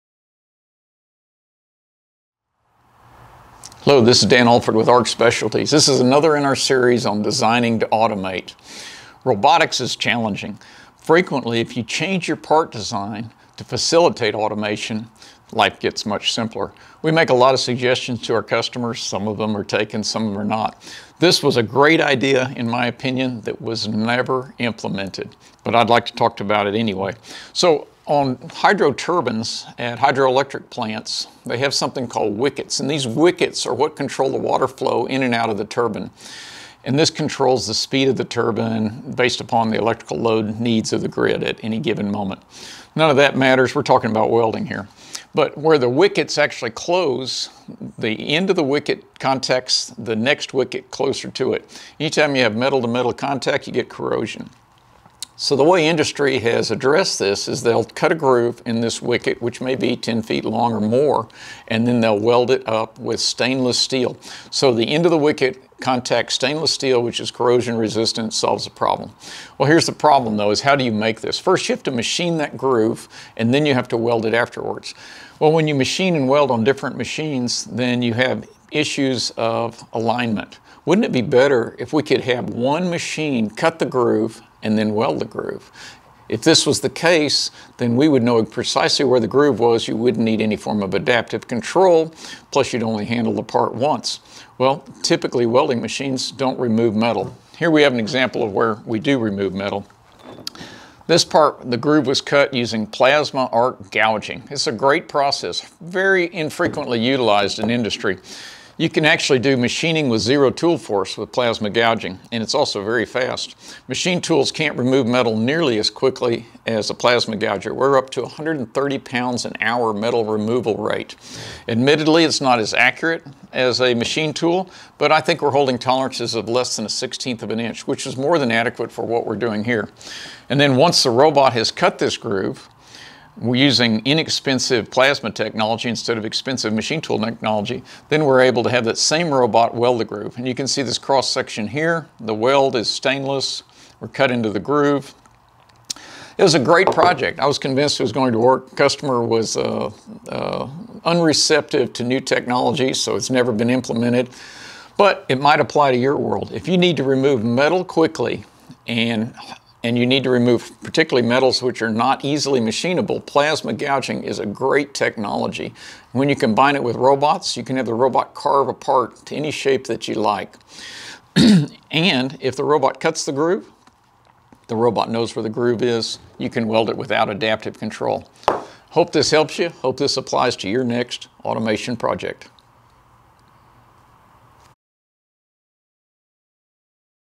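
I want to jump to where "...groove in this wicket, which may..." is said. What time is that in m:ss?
0:58.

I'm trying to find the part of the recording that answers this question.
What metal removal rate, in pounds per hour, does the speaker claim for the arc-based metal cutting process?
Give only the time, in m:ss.
1:58.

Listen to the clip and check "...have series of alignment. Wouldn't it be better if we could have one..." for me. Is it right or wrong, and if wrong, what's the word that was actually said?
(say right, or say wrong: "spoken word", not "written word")
wrong: "issues", not "series".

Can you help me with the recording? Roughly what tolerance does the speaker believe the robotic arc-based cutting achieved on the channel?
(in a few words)
Less than 1/16 inch.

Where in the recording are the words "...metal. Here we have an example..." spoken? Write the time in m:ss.
1:36.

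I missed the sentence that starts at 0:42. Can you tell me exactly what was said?
None of that matters, we're talking about welding here.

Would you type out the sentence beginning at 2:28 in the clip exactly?
Customer was uh, uh, unreceptive to new technology, so it's never been implemented.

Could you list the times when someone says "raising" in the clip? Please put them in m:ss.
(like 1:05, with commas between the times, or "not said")
not said.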